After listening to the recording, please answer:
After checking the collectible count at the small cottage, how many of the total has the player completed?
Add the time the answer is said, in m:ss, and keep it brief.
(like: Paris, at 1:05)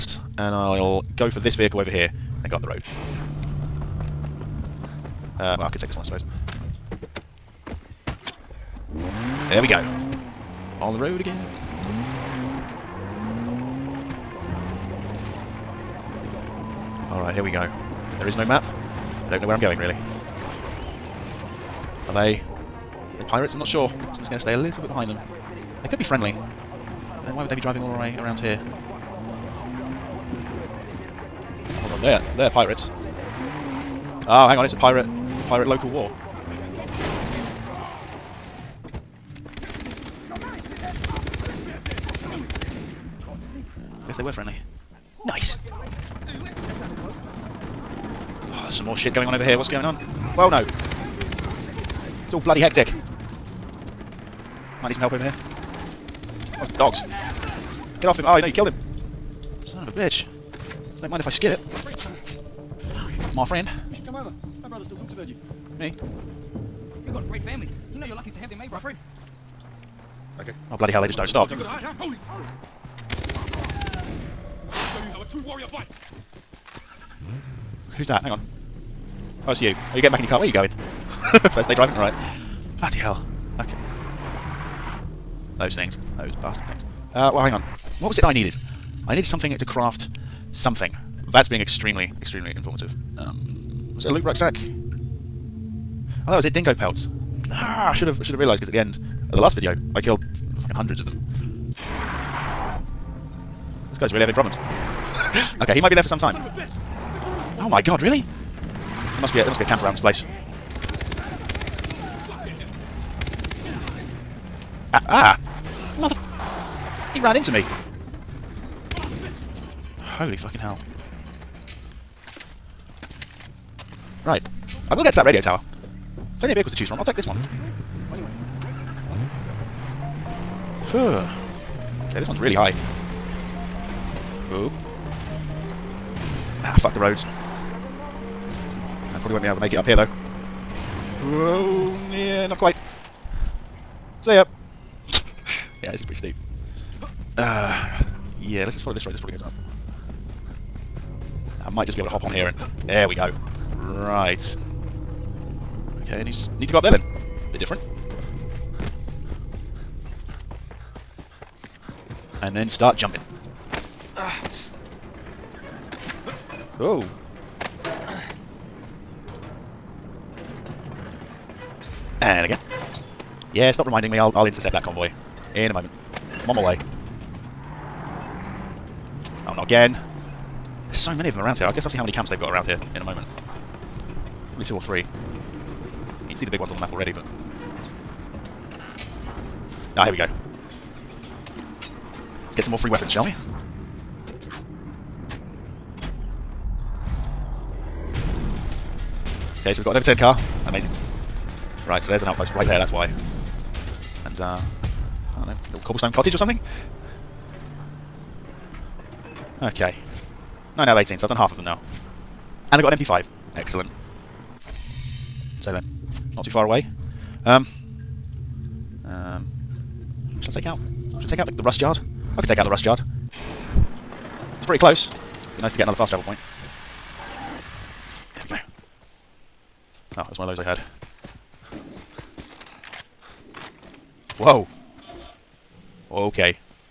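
9 out of 18, at 3:30.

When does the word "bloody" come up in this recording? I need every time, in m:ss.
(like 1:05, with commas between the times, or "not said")
0:52, 1:10, 1:22.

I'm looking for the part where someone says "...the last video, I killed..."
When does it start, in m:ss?
1:39.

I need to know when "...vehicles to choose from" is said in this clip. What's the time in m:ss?
2:06.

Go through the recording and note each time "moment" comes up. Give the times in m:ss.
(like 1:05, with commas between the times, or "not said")
2:55, 3:03.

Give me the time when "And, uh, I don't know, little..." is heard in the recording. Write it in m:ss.
3:24.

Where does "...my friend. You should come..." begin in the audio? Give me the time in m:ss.
1:03.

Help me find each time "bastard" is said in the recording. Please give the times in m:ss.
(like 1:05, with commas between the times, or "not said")
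1:26.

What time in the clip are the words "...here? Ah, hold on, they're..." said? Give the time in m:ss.
0:28.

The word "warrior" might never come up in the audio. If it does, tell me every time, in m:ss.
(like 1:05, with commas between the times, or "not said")
1:15.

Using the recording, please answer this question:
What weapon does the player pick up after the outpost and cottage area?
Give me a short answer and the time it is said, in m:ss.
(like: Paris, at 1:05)
MP5, at 3:32.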